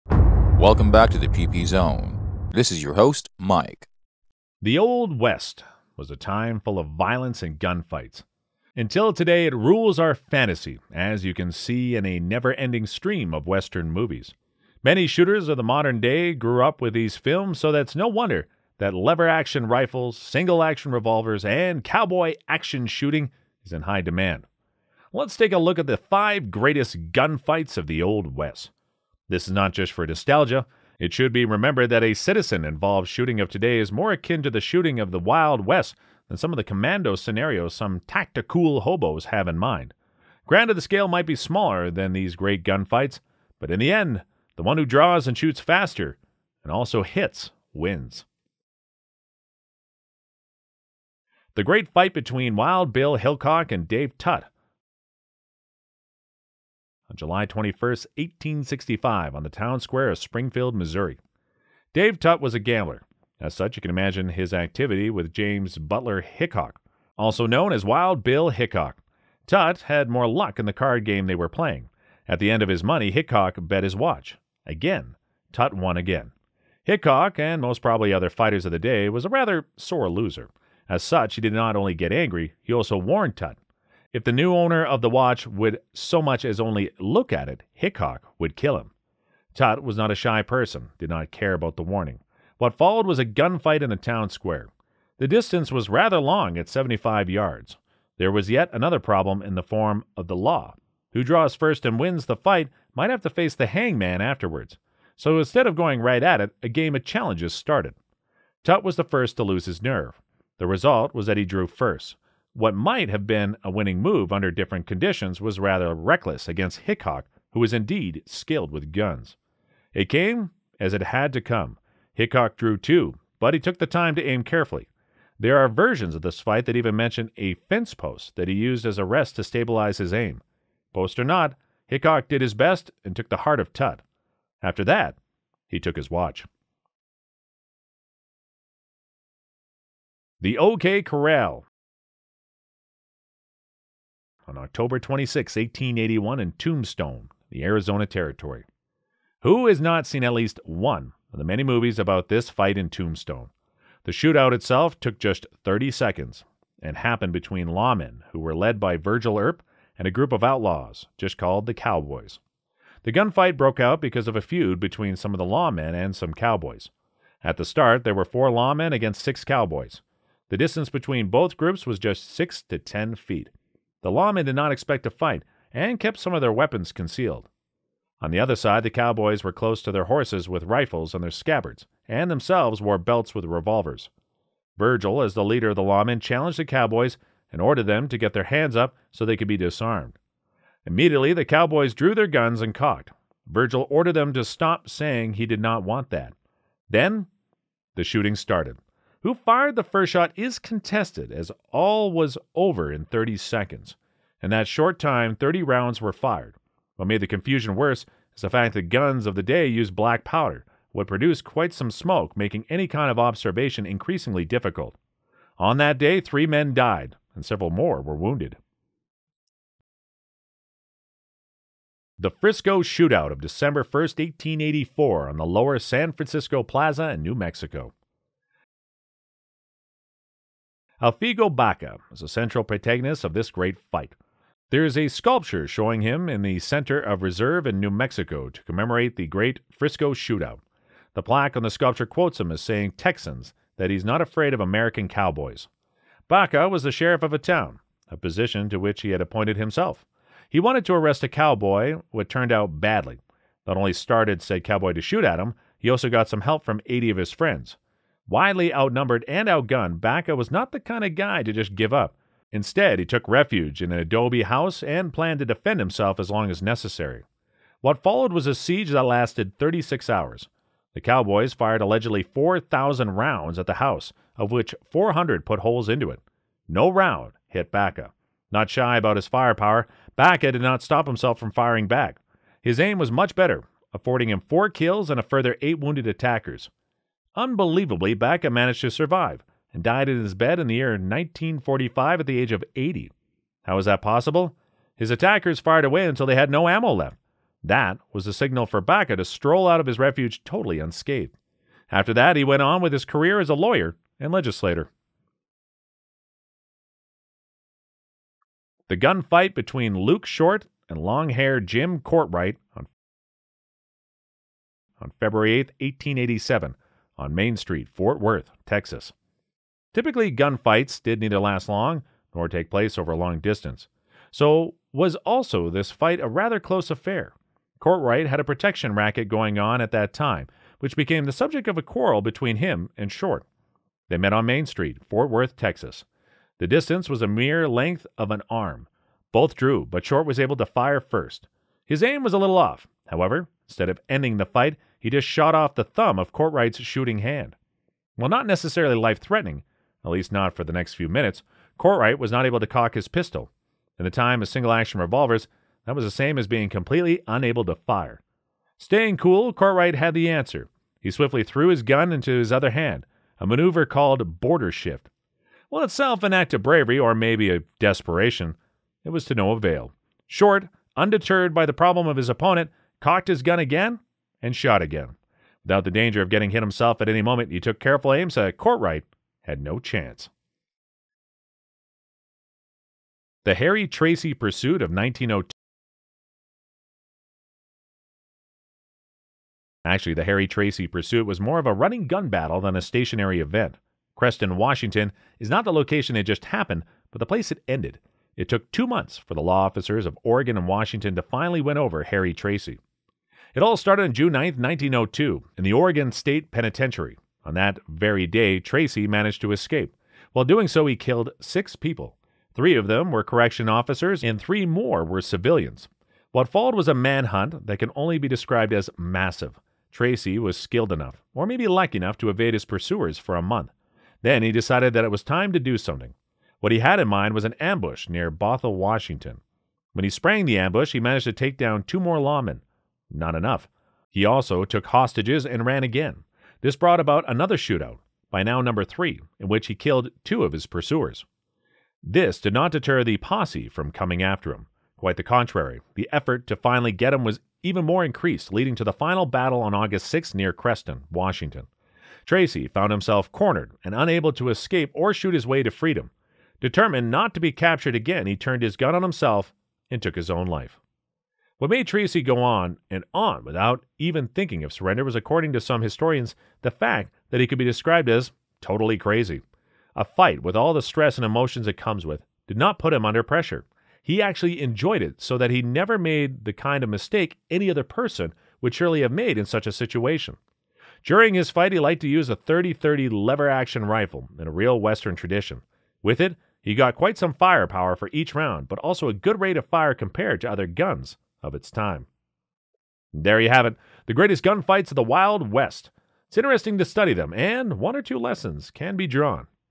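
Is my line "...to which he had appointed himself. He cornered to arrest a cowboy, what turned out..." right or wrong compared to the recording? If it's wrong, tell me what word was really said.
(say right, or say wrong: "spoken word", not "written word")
wrong: "wanted", not "cornered".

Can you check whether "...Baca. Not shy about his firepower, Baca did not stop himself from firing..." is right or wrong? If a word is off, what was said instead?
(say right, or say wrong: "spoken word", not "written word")
right.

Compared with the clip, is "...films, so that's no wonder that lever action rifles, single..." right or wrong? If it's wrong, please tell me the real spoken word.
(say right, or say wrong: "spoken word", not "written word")
right.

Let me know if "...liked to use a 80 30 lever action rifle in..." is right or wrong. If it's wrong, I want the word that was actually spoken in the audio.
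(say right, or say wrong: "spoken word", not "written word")
wrong: "30", not "80".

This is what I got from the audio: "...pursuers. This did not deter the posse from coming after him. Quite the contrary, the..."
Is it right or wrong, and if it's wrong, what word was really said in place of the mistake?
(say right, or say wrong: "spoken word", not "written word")
right.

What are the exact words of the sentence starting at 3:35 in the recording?
On that day, three men died, and several more were wounded.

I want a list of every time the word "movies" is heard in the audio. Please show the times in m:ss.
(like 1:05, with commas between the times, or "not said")
0:13, 2:31.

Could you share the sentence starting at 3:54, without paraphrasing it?
There is a sculpture showing him in the center of Reserve in New Mexico to commemorate the great Frisco shootout.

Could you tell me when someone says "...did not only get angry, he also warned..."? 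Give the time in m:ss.
1:21.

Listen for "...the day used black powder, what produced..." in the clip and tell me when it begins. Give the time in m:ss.
3:29.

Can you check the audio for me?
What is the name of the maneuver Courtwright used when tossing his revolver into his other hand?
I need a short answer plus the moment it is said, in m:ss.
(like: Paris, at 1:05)
border shift, at 6:04.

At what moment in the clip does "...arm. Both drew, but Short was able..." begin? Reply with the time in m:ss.
5:38.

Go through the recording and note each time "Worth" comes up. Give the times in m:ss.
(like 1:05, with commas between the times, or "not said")
5:18, 5:35.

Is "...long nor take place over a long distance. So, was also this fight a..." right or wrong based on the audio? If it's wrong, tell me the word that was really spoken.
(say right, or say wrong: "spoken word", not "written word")
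right.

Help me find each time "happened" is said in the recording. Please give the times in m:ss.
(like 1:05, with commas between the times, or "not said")
2:36, 6:36.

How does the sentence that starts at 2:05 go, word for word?
There are versions of this fight that even mention a fence post that he used as a rest to stabilize his aim.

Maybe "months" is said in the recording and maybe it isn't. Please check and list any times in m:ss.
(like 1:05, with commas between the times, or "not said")
6:38, 7:03.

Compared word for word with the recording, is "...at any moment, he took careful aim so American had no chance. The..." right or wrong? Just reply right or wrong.
wrong.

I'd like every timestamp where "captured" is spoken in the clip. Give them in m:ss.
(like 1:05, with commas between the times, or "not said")
7:37.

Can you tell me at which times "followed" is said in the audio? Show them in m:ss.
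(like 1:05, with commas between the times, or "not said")
1:32, 4:28, 6:56.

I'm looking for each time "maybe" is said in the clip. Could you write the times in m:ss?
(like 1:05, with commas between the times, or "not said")
6:07, 7:01.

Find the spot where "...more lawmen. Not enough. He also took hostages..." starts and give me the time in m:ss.
7:11.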